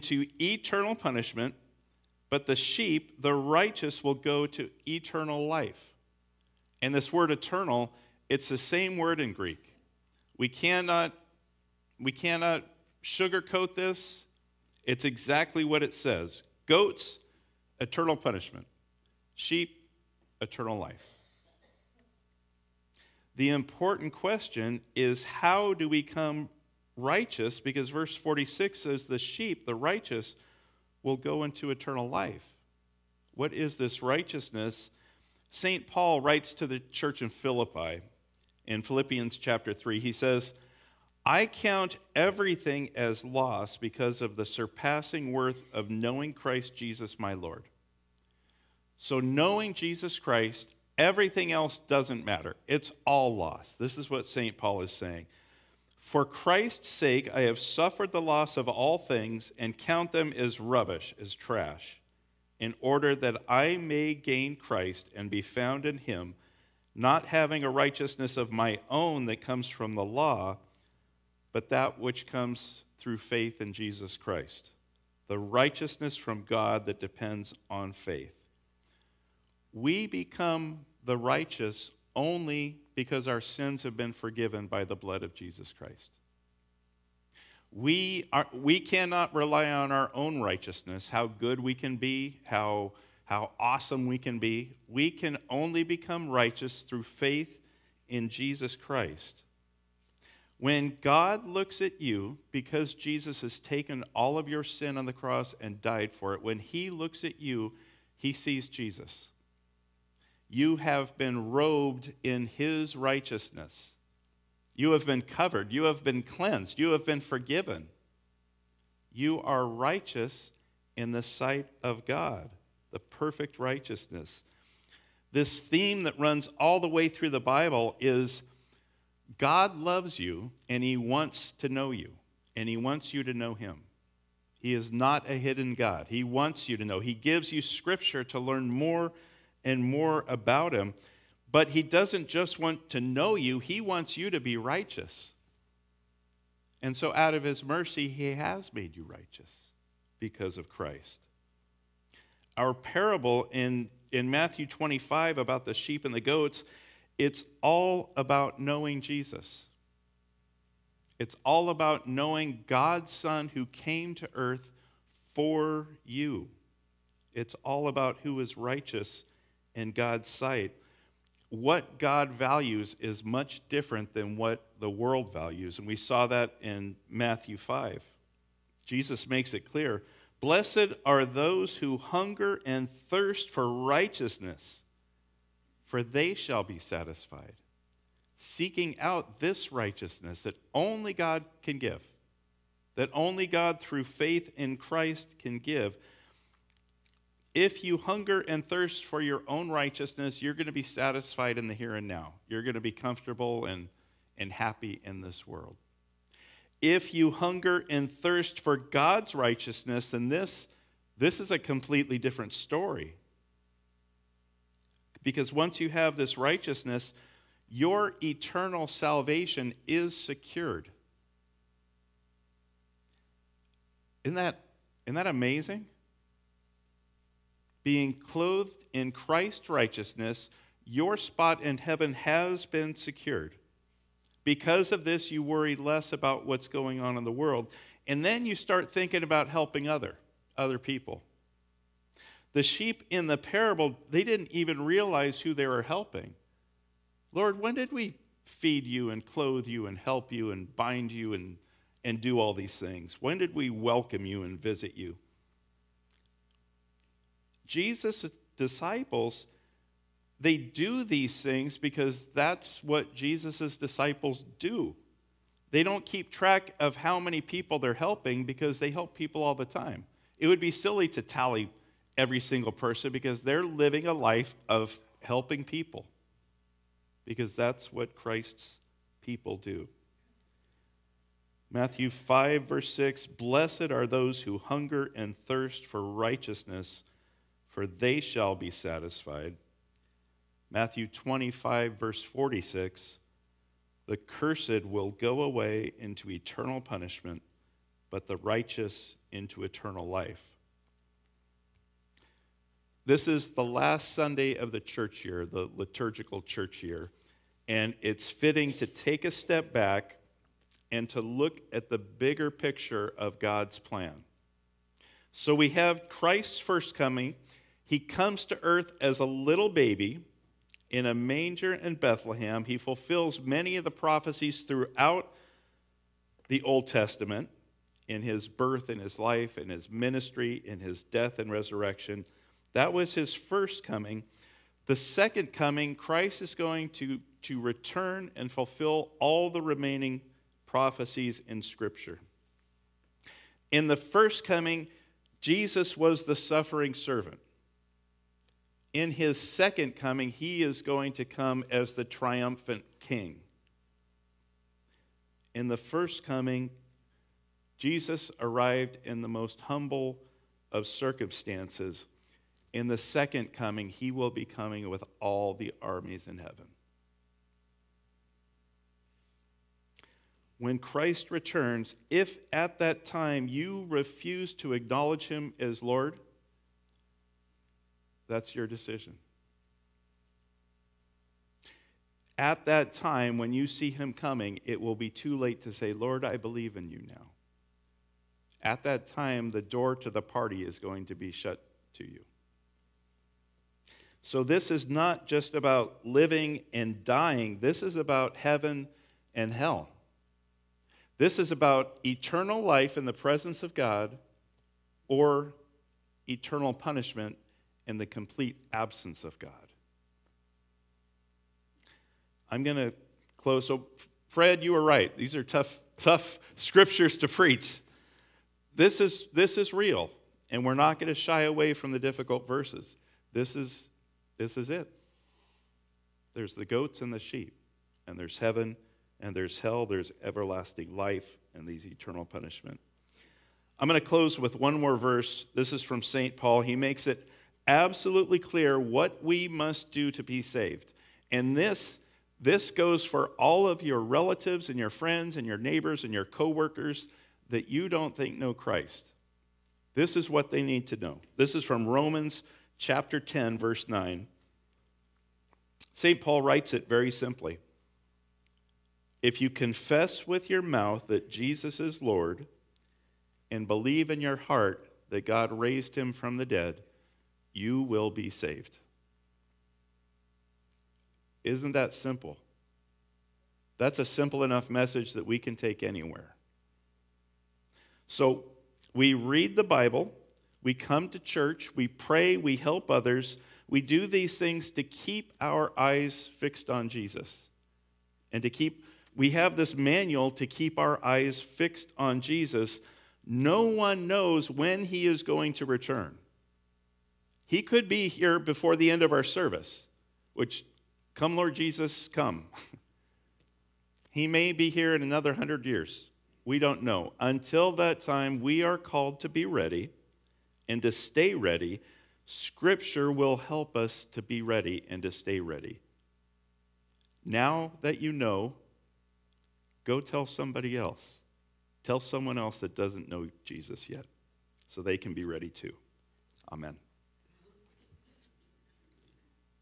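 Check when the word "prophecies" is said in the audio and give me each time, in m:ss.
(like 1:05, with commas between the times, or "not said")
5:23, 5:40.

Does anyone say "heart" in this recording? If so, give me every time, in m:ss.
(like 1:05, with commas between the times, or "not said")
7:44.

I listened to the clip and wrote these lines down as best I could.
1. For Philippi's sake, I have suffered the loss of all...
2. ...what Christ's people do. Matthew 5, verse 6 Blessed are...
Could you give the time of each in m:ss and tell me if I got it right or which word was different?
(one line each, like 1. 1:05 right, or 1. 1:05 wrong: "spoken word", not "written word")
1. 0:55 wrong: "Christ", not "Philippi"
2. 4:37 right.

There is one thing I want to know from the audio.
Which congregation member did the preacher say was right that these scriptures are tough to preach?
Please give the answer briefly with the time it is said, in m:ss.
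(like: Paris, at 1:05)
Fred, at 6:54.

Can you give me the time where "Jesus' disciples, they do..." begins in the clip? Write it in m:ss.
4:17.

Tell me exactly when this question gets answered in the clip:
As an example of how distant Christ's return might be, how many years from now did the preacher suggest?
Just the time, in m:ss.
8:25.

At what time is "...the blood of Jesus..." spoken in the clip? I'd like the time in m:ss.
1:24.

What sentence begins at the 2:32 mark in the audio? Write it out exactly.
Our parable in, in Matthew 25 about the sheep and the goats, it's all about knowing Jesus.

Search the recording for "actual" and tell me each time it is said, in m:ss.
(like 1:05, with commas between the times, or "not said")
not said.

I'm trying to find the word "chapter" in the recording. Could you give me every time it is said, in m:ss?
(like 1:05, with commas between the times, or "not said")
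0:39, 7:32.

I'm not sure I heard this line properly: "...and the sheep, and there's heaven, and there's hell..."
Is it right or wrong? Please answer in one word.
right.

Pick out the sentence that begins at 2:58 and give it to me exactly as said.
Jesus makes it clear Blessed are those who hunger and thirst for righteousness, for they shall be satisfied.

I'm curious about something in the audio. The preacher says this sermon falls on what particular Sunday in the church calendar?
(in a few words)
Last Sunday of the church year.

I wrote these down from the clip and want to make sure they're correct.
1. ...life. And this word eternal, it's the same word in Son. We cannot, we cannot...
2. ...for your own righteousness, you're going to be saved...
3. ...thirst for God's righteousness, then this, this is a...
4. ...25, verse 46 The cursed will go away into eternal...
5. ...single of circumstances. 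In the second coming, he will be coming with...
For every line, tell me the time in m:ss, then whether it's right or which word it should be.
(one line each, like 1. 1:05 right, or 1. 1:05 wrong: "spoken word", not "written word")
1. 0:05 wrong: "Greek", not "Son"
2. 3:19 wrong: "satisfied", not "saved"
3. 3:28 right
4. 4:51 right
5. 5:59 wrong: "humble", not "single".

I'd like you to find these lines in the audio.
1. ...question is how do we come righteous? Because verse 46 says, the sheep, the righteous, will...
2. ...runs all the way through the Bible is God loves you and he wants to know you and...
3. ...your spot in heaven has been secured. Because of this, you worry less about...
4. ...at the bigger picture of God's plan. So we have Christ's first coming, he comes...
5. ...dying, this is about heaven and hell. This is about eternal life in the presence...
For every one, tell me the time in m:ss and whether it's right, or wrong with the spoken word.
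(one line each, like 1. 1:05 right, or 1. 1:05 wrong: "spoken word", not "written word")
1. 0:24 right
2. 2:06 right
3. 3:50 right
4. 5:11 right
5. 6:37 right.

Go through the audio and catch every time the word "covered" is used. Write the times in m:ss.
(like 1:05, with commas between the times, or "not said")
1:55.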